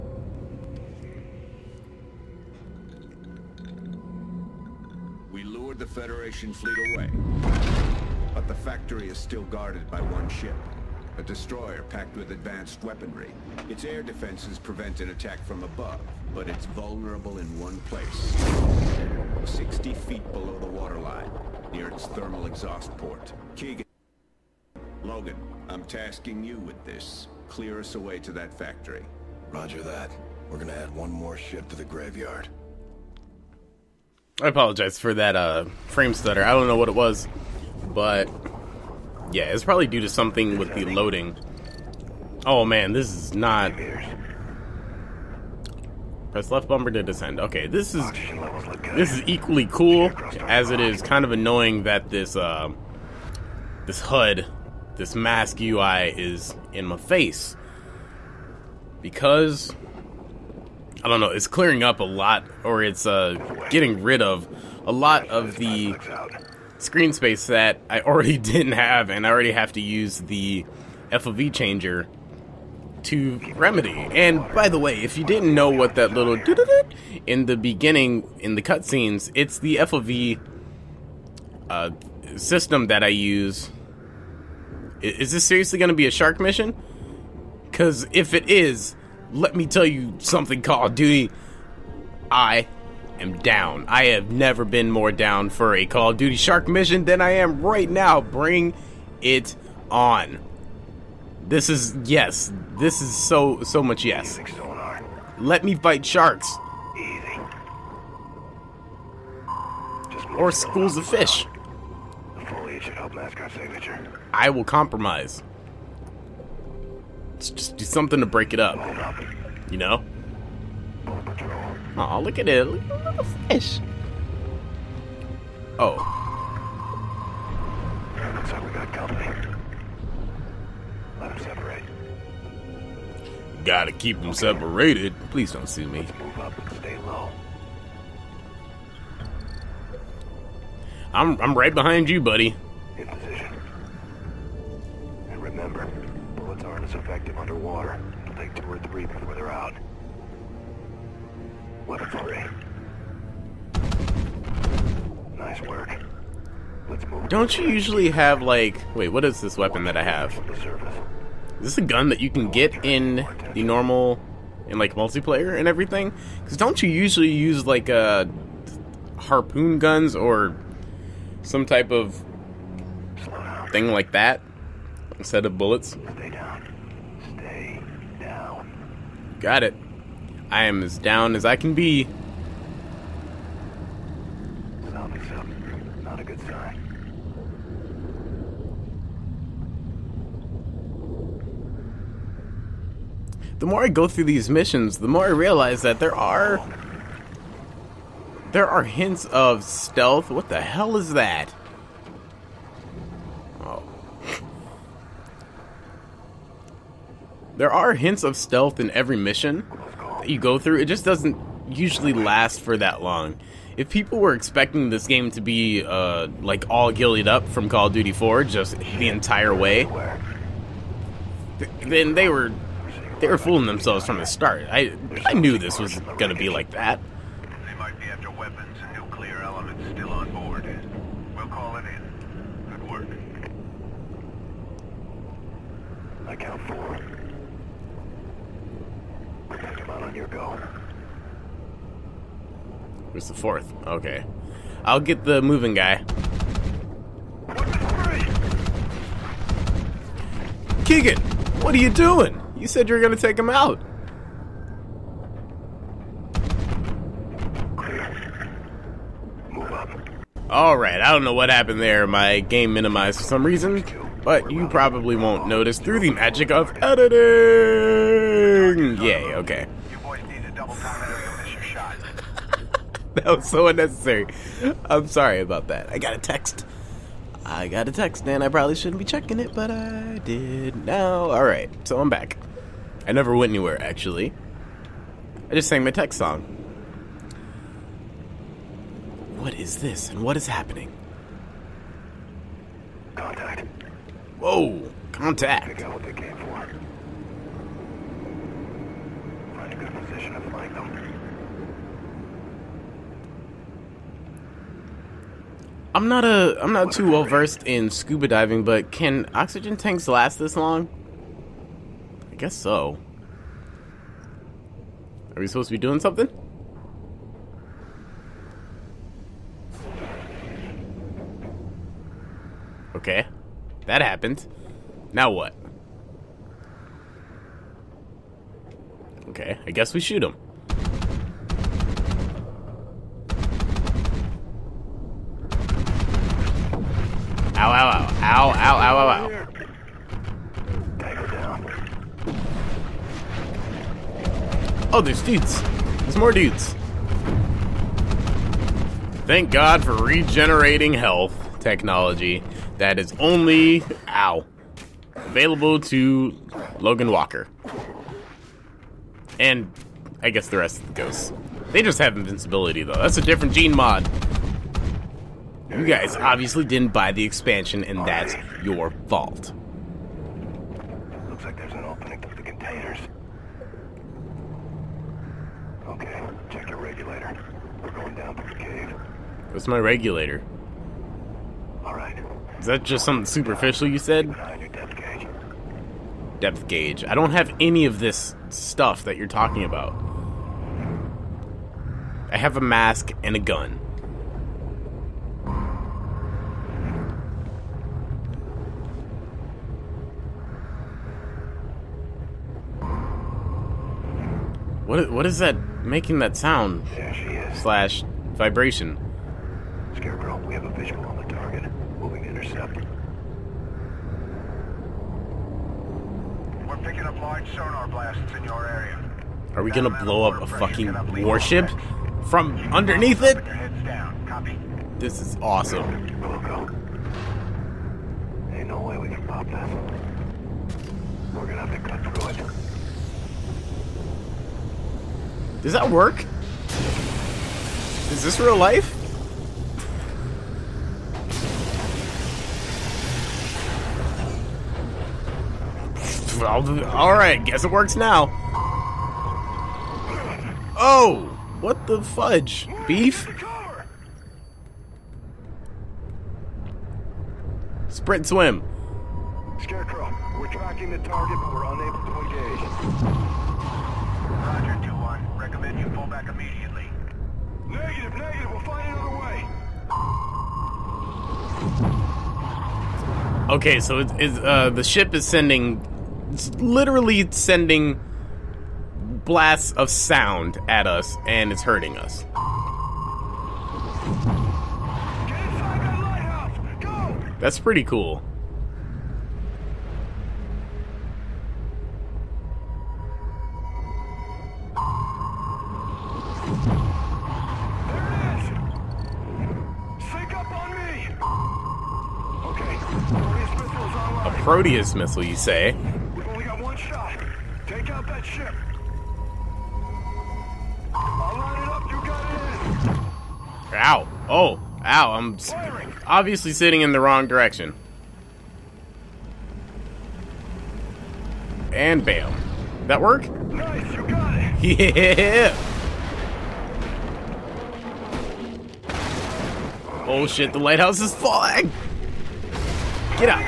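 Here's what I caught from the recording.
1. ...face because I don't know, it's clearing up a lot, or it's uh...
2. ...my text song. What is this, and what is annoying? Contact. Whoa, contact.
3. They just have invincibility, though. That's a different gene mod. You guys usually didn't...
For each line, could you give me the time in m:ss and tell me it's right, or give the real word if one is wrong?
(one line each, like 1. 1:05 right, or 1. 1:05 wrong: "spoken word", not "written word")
1. 0:56 right
2. 4:45 wrong: "happening", not "annoying"
3. 6:01 wrong: "obviously", not "usually".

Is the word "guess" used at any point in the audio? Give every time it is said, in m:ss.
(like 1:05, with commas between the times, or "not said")
5:12, 5:29, 6:00, 7:27.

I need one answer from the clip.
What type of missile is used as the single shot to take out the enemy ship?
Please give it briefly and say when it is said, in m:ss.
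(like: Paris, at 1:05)
Proteus, at 8:24.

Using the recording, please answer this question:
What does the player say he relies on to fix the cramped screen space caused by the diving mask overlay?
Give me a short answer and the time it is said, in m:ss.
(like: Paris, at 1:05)
FOV changer, at 1:11.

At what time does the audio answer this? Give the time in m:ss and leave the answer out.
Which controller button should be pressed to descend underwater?
0:46.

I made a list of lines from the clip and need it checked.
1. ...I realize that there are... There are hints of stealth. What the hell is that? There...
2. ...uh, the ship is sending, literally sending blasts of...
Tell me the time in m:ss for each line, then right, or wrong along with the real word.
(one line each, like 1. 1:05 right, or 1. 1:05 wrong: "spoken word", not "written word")
1. 3:15 right
2. 7:54 right.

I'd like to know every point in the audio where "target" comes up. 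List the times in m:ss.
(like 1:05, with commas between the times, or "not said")
6:51, 7:40.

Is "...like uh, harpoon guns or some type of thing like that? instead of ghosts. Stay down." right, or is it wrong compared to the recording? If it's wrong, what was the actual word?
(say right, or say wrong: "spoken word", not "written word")
wrong: "bullets", not "ghosts".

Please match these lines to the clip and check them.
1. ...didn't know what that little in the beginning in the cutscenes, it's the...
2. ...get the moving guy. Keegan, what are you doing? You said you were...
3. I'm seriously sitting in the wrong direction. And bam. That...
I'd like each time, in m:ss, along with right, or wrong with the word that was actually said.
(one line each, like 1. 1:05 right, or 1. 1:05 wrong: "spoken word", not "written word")
1. 1:15 right
2. 4:04 right
3. 8:35 wrong: "obviously", not "seriously".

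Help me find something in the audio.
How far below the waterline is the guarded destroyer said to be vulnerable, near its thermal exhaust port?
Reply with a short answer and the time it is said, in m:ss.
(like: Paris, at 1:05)
60 feet, at 0:19.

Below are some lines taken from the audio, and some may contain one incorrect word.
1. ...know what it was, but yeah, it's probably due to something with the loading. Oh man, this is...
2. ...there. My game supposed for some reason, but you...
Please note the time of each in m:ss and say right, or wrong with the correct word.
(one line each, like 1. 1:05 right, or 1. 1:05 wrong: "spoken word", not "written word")
1. 0:36 right
2. 4:21 wrong: "minimized", not "supposed".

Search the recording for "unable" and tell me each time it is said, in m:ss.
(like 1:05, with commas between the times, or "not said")
7:41.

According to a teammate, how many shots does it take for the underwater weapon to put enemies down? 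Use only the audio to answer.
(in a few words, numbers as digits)
Two or three.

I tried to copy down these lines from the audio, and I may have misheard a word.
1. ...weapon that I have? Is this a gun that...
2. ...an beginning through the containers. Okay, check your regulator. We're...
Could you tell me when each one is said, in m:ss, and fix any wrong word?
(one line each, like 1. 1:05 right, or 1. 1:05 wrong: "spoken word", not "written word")
1. 2:39 right
2. 6:11 wrong: "opening", not "beginning".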